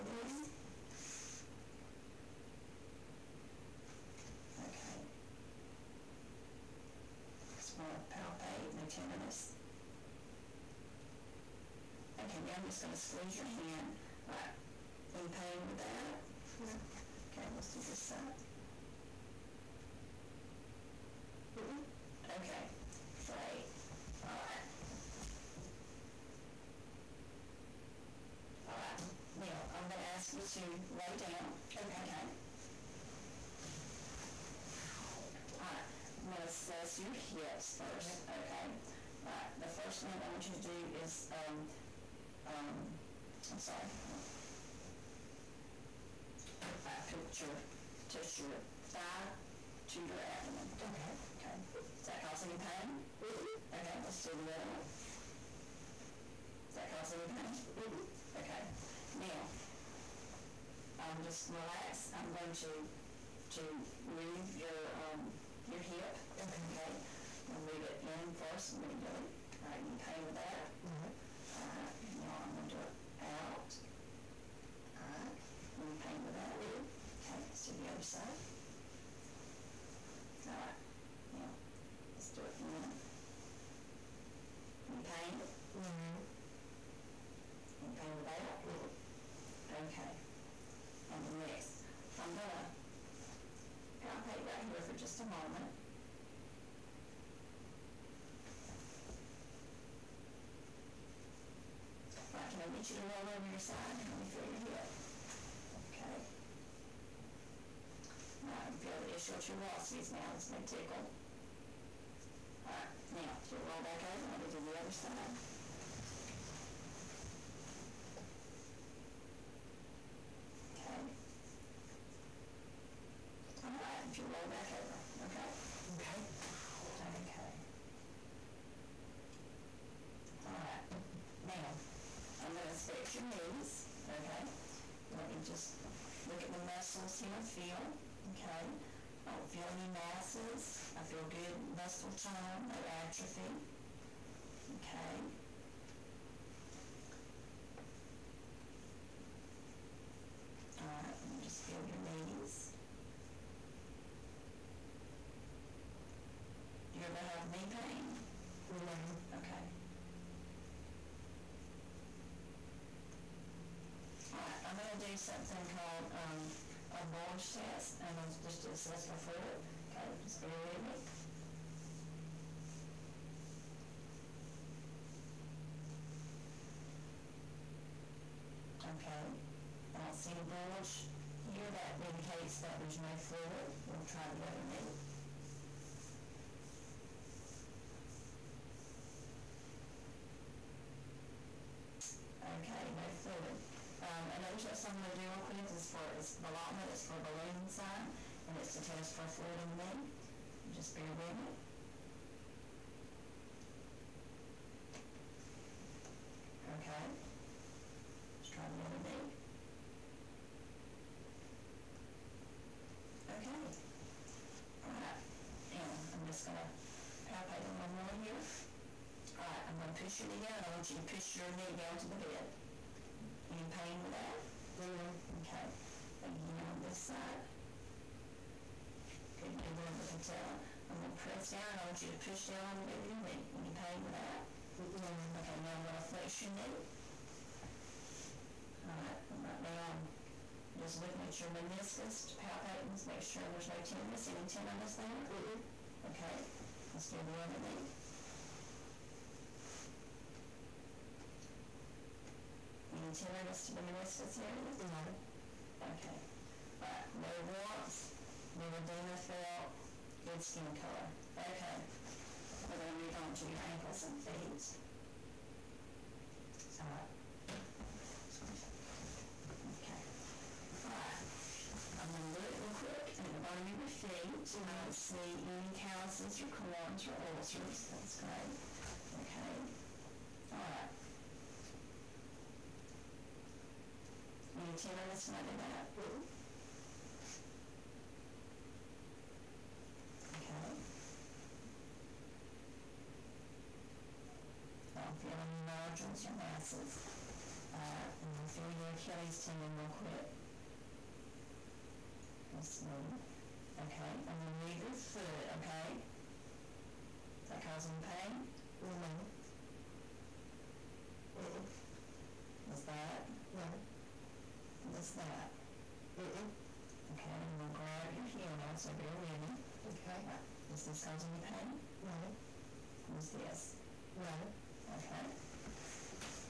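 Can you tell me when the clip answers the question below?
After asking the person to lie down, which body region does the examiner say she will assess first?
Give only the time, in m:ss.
0:37.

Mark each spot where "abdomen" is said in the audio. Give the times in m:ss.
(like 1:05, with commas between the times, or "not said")
0:50.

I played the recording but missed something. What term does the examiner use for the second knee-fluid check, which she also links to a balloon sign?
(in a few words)
Ballottement.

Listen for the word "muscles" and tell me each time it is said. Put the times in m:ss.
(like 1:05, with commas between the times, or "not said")
2:16, 2:21.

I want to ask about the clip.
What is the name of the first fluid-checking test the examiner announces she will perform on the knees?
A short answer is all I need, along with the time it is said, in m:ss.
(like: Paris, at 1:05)
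Bulge test, at 2:47.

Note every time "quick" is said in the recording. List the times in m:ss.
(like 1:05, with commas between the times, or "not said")
3:15, 4:32, 4:59.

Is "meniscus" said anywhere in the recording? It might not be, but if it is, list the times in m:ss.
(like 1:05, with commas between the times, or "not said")
4:01, 4:13.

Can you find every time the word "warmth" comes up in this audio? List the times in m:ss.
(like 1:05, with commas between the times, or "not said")
4:17.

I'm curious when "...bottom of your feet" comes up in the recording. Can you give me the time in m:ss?
4:33.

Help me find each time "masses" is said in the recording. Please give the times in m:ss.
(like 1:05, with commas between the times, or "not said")
2:19, 4:56.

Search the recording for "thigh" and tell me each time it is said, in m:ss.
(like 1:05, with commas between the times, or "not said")
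0:48.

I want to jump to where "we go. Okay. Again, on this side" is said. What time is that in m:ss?
3:44.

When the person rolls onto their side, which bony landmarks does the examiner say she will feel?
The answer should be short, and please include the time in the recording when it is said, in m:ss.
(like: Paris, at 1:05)
Ischial tuberosities, at 1:49.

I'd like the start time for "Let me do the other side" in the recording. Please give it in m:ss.
1:54.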